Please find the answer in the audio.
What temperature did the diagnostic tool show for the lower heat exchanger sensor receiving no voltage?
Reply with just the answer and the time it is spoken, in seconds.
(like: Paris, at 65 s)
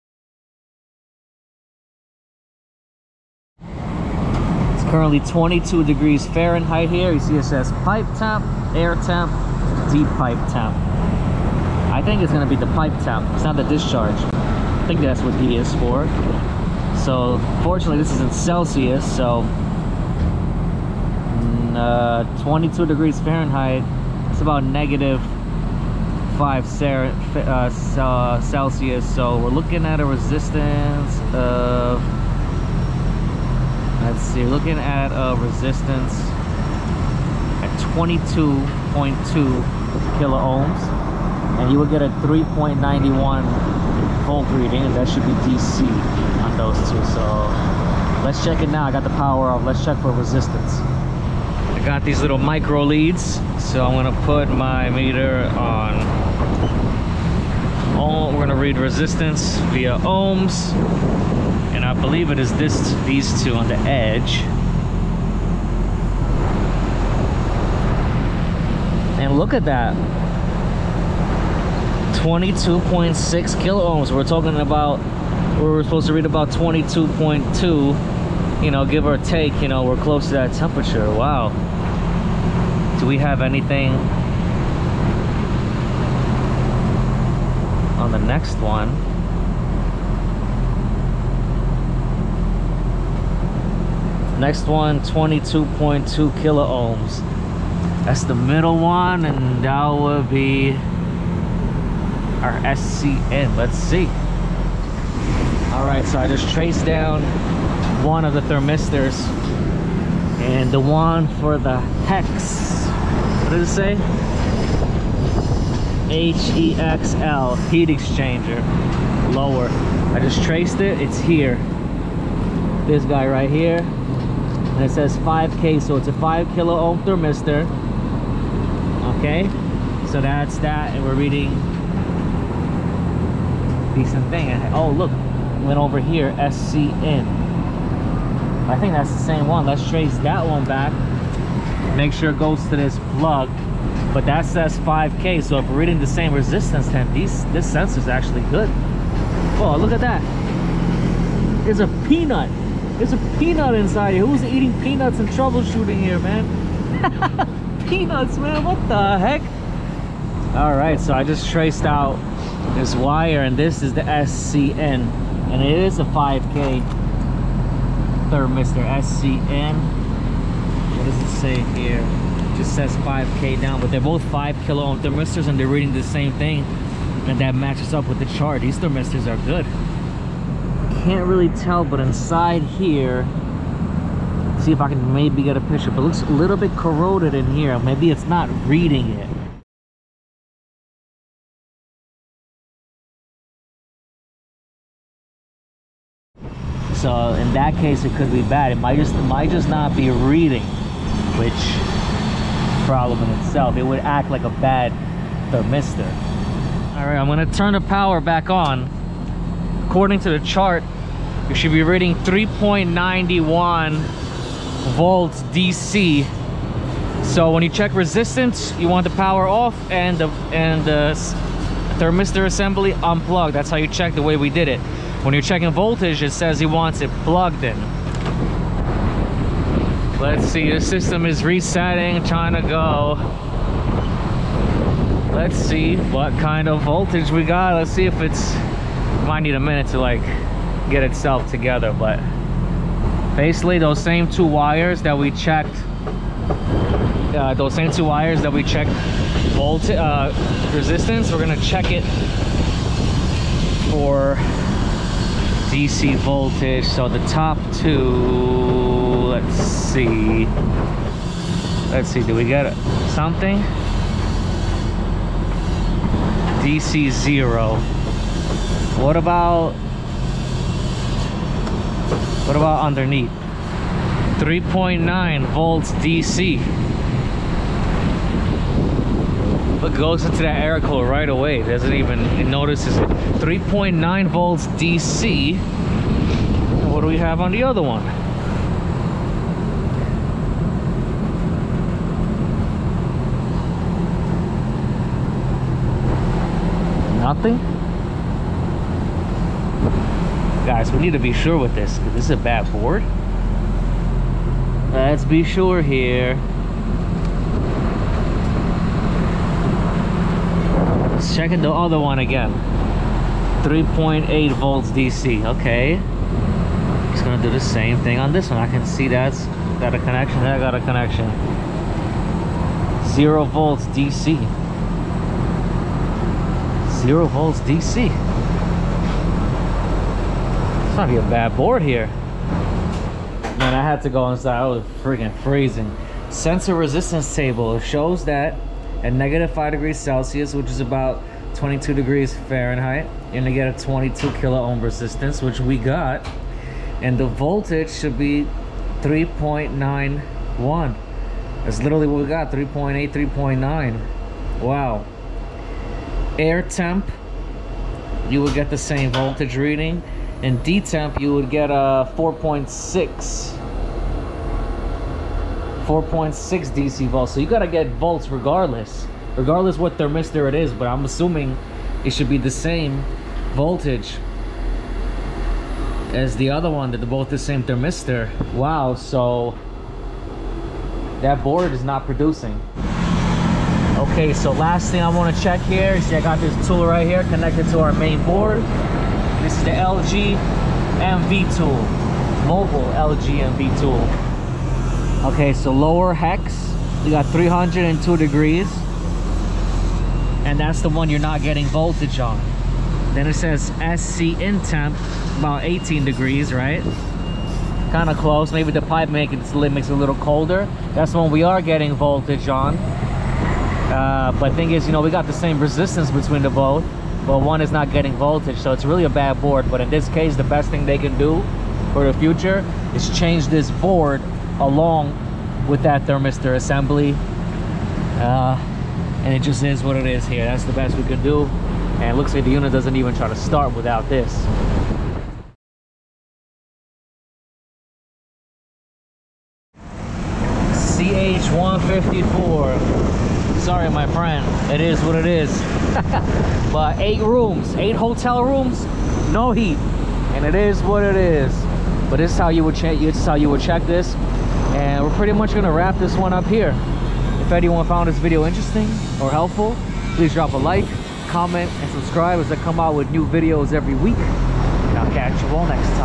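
302 degrees, at 397 s.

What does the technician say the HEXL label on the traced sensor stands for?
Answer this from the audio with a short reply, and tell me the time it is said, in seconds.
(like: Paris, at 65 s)
heat exchanger lower, at 117 s.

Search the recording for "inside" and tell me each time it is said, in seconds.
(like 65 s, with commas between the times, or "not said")
153 s, 182 s, 334 s.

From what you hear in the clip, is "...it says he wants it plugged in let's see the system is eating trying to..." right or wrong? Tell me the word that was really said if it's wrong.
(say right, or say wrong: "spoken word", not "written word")
wrong: "resetting", not "eating".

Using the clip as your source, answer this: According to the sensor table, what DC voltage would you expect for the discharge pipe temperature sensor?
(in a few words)
4.6 volts.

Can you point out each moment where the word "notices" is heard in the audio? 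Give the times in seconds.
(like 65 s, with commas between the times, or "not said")
282 s.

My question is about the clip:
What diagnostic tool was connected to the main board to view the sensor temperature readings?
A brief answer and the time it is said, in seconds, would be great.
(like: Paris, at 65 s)
mobile LG MV tool, at 392 s.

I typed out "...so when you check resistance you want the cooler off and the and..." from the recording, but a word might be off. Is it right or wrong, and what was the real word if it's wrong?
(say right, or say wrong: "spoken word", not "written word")
wrong: "power", not "cooler".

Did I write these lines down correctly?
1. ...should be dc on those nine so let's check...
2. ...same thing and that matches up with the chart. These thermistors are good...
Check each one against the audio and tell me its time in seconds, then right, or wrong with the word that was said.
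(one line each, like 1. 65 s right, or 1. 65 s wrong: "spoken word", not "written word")
1. 45 s wrong: "two", not "nine"
2. 176 s right.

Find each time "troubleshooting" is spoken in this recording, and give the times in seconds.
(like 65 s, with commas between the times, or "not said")
155 s.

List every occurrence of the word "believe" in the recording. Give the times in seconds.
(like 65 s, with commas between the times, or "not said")
61 s.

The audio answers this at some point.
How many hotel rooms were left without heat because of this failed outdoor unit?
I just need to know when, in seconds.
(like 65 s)
447 s.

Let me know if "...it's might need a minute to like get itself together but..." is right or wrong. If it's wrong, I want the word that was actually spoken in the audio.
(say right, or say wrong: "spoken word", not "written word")
right.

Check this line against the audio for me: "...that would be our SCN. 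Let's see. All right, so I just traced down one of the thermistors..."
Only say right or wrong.
right.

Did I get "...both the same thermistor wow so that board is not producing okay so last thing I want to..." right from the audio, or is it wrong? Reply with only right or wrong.
right.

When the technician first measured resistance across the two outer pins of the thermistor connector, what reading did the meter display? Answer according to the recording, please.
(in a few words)
22.6 kilo ohms.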